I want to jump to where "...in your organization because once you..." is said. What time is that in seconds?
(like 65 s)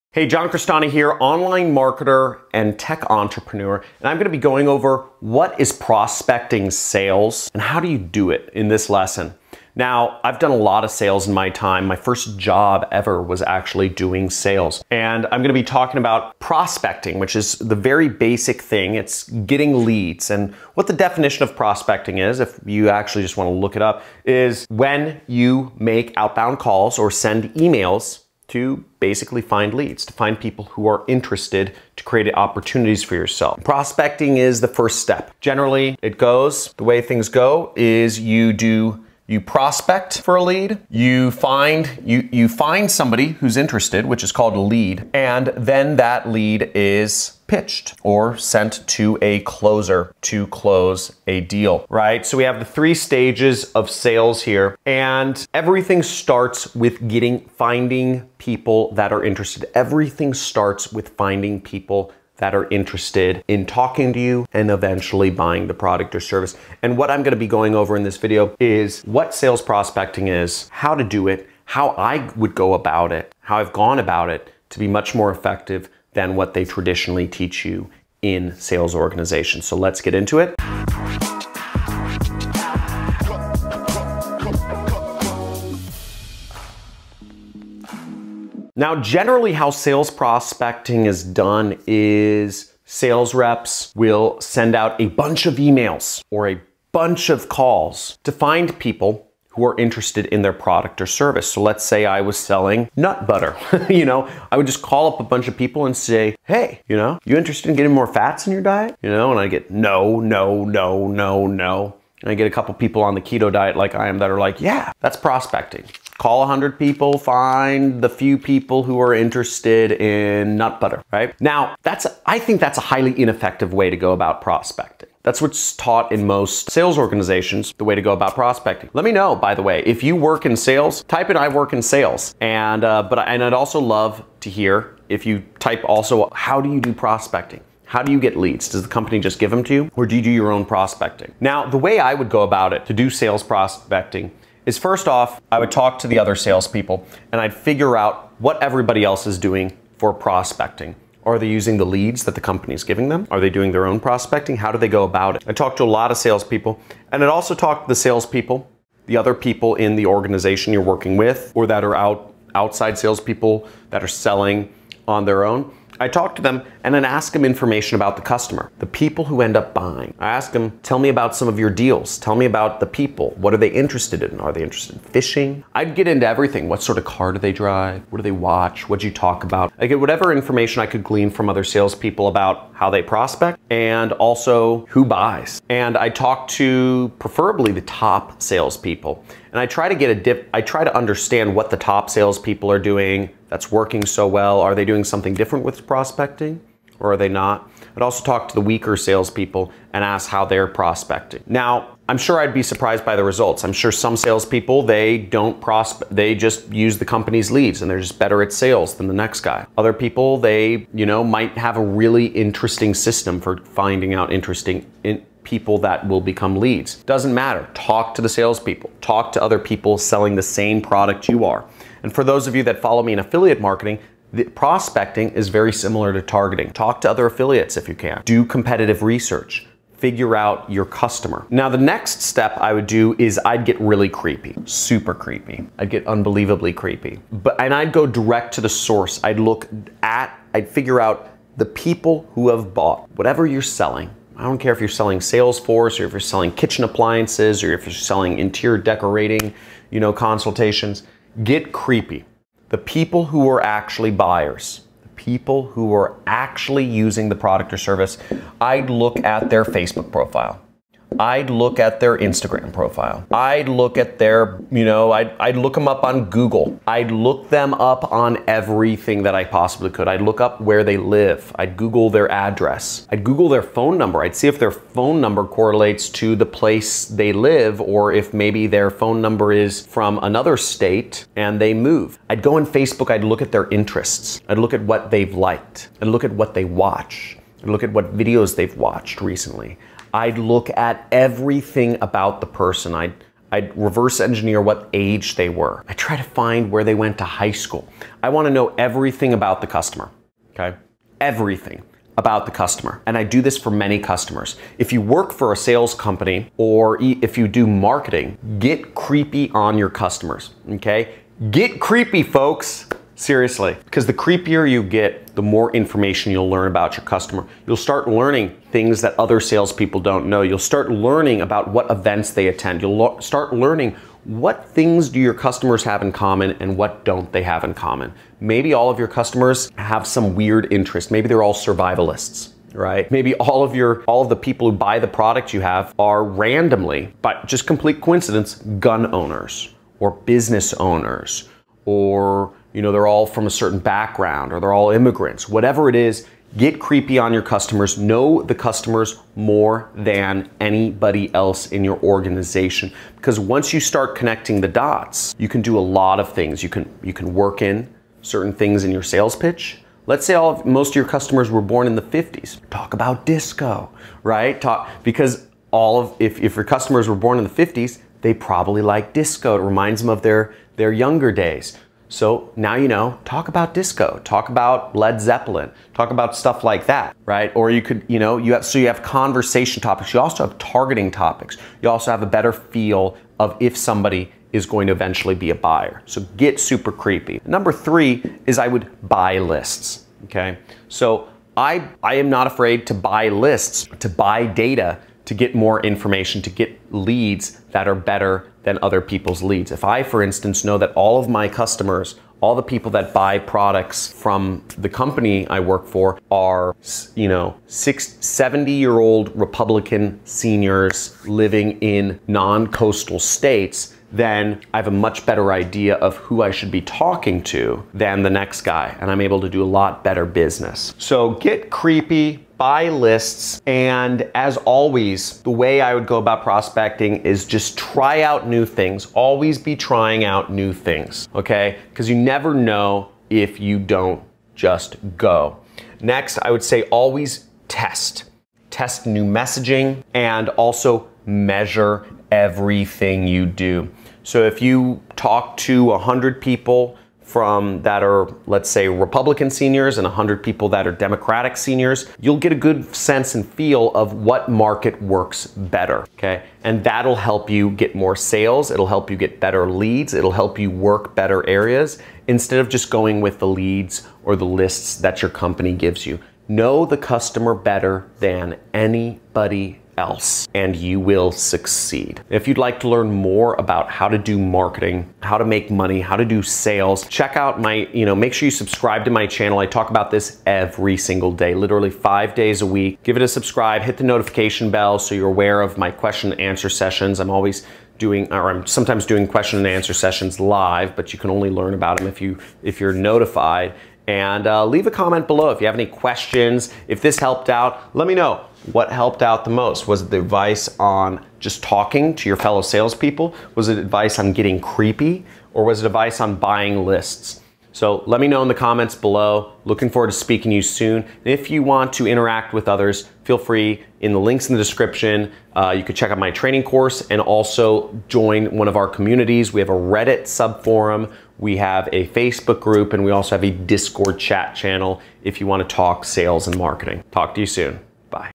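351 s.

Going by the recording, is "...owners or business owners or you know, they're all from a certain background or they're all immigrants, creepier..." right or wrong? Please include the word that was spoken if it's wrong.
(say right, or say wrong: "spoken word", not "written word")
wrong: "whatever", not "creepier".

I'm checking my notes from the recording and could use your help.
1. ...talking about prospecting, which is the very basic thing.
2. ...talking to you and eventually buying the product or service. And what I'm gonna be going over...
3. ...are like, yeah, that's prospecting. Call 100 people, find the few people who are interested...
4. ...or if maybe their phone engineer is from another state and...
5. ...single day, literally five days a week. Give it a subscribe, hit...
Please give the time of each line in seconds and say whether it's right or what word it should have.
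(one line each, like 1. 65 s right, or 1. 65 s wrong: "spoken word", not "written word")
1. 15 s right
2. 63 s right
3. 114 s right
4. 277 s wrong: "number", not "engineer"
5. 480 s right.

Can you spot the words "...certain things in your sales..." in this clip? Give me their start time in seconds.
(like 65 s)
358 s.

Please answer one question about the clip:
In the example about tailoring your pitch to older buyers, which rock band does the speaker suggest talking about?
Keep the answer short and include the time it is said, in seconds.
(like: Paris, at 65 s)
Led Zeppelin, at 374 s.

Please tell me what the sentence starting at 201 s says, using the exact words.
Now, I'm sure I'd be surprised by the results.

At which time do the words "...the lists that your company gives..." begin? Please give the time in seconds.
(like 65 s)
464 s.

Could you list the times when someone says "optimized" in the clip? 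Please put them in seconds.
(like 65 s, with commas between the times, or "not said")
not said.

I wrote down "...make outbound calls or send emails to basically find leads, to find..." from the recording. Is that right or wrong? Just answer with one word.
right.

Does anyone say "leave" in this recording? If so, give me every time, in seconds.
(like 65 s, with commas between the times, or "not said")
494 s.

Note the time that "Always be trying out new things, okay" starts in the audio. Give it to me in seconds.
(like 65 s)
429 s.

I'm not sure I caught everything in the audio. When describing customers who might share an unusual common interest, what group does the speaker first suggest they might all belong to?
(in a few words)
Survivalists.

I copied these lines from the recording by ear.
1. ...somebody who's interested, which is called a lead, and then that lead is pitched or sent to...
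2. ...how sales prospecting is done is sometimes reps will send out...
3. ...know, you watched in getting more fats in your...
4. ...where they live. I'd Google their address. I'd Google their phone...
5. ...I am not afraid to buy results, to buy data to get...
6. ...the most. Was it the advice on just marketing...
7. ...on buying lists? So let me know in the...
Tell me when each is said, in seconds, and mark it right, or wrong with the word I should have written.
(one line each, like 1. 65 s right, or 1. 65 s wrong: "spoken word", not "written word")
1. 42 s right
2. 89 s wrong: "sales", not "sometimes"
3. 106 s wrong: "interested", not "watched"
4. 270 s right
5. 392 s wrong: "lists", not "results"
6. 499 s wrong: "talking", not "marketing"
7. 506 s right.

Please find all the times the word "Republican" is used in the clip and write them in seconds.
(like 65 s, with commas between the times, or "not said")
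409 s, 448 s.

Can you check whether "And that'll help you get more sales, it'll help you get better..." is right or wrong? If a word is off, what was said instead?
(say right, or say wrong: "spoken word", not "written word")
right.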